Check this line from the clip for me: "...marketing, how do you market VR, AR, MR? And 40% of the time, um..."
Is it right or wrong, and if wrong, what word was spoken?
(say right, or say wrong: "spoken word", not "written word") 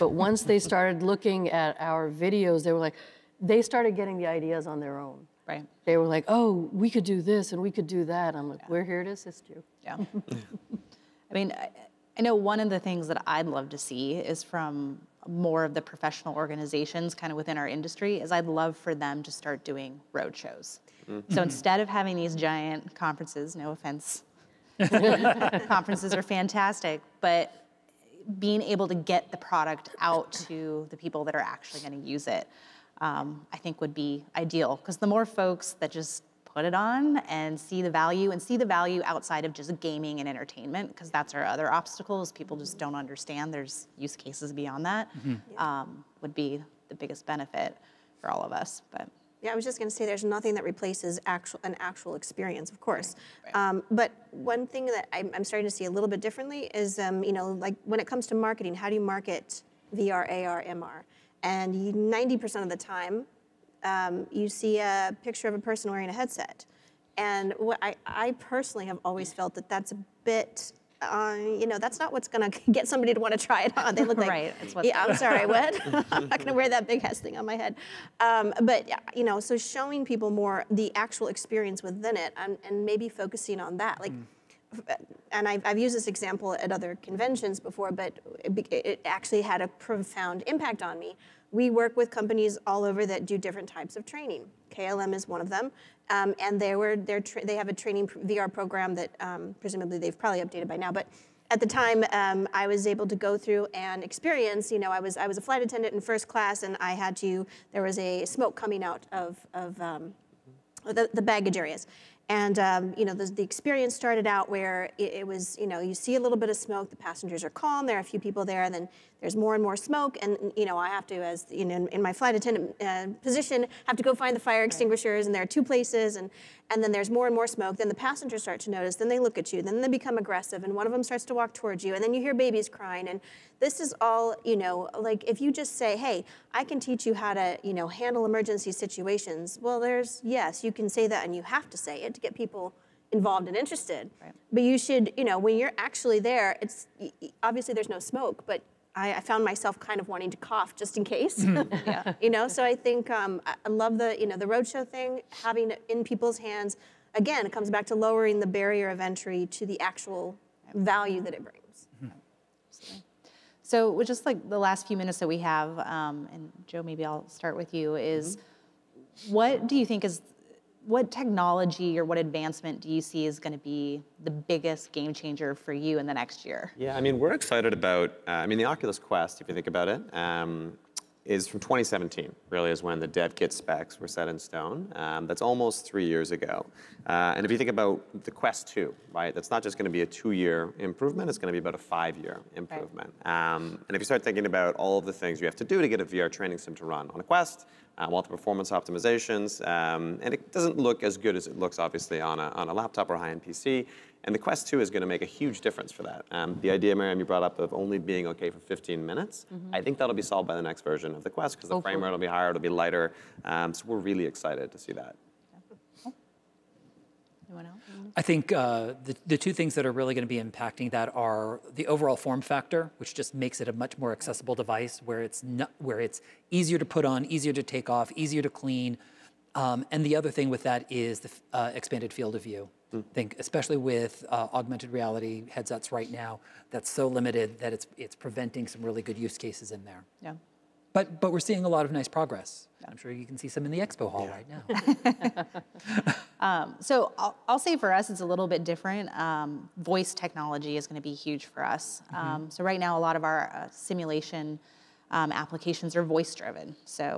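wrong: "90", not "40".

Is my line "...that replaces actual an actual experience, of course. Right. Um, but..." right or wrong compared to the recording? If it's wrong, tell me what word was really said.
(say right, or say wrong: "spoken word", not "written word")
right.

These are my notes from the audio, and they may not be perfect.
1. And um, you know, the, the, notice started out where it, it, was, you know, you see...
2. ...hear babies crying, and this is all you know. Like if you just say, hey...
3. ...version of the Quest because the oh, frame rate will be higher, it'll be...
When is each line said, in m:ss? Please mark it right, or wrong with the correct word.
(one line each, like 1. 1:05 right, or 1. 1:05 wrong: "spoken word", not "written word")
1. 1:52 wrong: "experience", not "notice"
2. 2:12 right
3. 3:30 right.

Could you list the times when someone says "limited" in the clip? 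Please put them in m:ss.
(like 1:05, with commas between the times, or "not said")
3:57.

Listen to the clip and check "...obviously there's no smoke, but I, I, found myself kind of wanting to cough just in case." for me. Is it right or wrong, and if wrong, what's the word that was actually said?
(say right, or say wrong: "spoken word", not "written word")
right.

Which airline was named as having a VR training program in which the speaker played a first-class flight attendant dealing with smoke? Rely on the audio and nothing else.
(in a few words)
KLM.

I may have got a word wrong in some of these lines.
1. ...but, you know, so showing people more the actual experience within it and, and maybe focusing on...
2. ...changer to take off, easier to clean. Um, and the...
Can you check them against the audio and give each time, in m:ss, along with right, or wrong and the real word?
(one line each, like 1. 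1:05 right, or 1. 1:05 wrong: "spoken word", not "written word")
1. 1:18 right
2. 3:47 wrong: "easier", not "changer".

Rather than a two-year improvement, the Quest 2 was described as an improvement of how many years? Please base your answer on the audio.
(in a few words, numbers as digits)
5.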